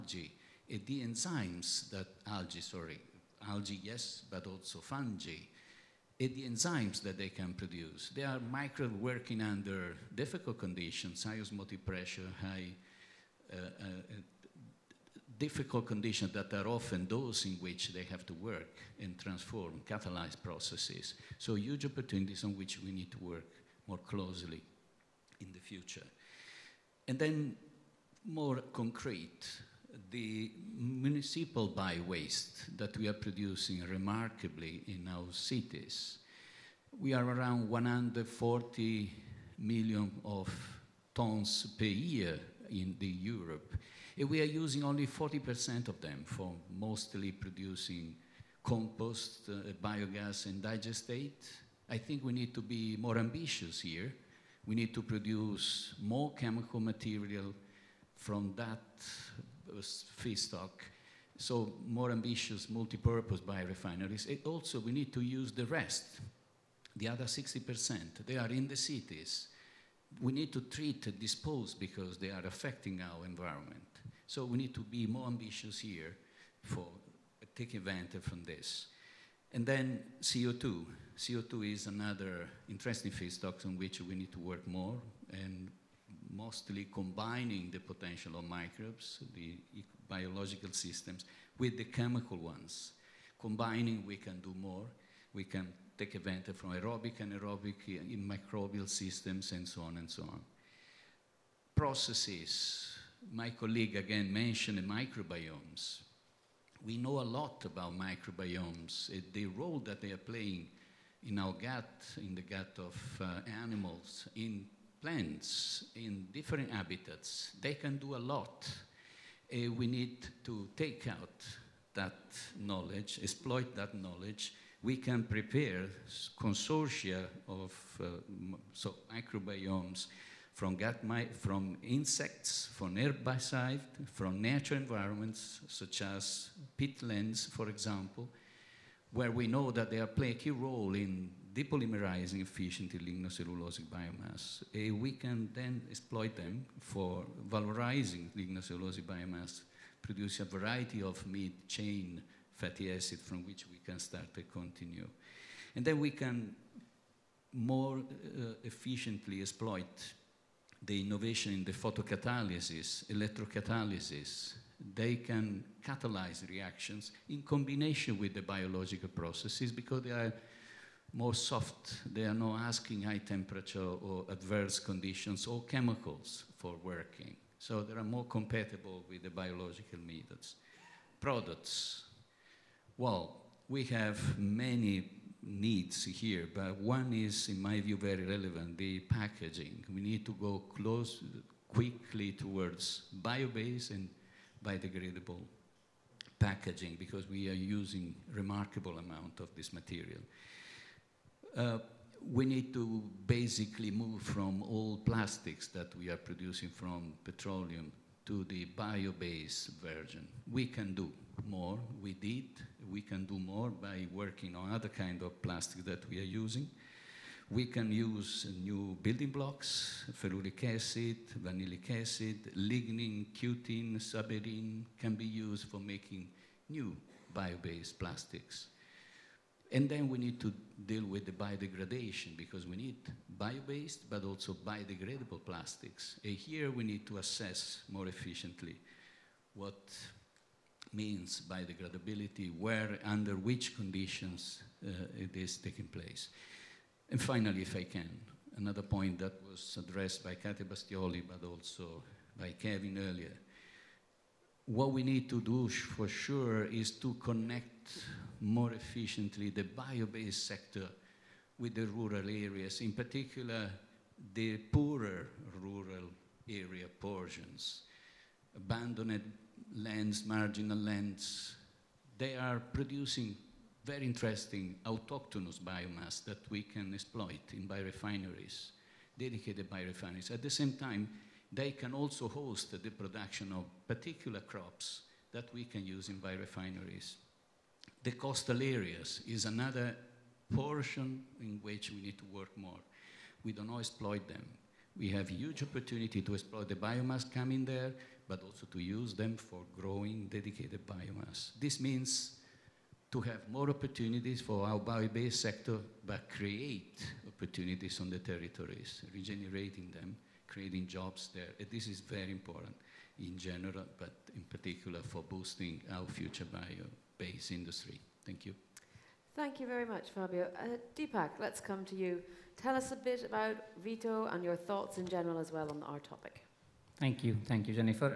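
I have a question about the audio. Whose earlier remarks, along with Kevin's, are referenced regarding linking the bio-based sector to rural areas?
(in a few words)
Katia Bastioli.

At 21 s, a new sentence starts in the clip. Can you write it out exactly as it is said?
So huge opportunities on which we need to work more closely in the future.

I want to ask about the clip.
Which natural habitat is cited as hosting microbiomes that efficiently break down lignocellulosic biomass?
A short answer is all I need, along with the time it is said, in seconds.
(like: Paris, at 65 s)
peatlands, at 136 s.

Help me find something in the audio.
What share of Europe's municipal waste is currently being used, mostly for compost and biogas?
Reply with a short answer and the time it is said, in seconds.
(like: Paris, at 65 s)
40%, at 45 s.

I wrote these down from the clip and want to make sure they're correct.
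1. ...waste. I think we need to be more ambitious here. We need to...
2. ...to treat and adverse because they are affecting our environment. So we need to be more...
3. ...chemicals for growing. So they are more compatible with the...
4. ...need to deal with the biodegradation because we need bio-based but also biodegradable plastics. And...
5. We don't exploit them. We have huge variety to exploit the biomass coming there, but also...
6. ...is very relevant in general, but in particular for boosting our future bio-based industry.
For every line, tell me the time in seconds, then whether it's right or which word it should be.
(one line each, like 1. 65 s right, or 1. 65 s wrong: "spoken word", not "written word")
1. 50 s wrong: "digestate", not "waste"
2. 70 s wrong: "dispose", not "adverse"
3. 175 s wrong: "working", not "growing"
4. 230 s right
5. 293 s wrong: "opportunity", not "variety"
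6. 311 s wrong: "important", not "relevant".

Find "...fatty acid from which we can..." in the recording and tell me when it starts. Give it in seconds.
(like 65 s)
152 s.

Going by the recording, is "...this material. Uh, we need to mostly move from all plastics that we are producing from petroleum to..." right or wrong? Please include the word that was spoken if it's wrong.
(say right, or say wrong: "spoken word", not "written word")
wrong: "basically", not "mostly".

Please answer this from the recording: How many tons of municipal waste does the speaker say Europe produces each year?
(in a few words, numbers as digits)
140 million.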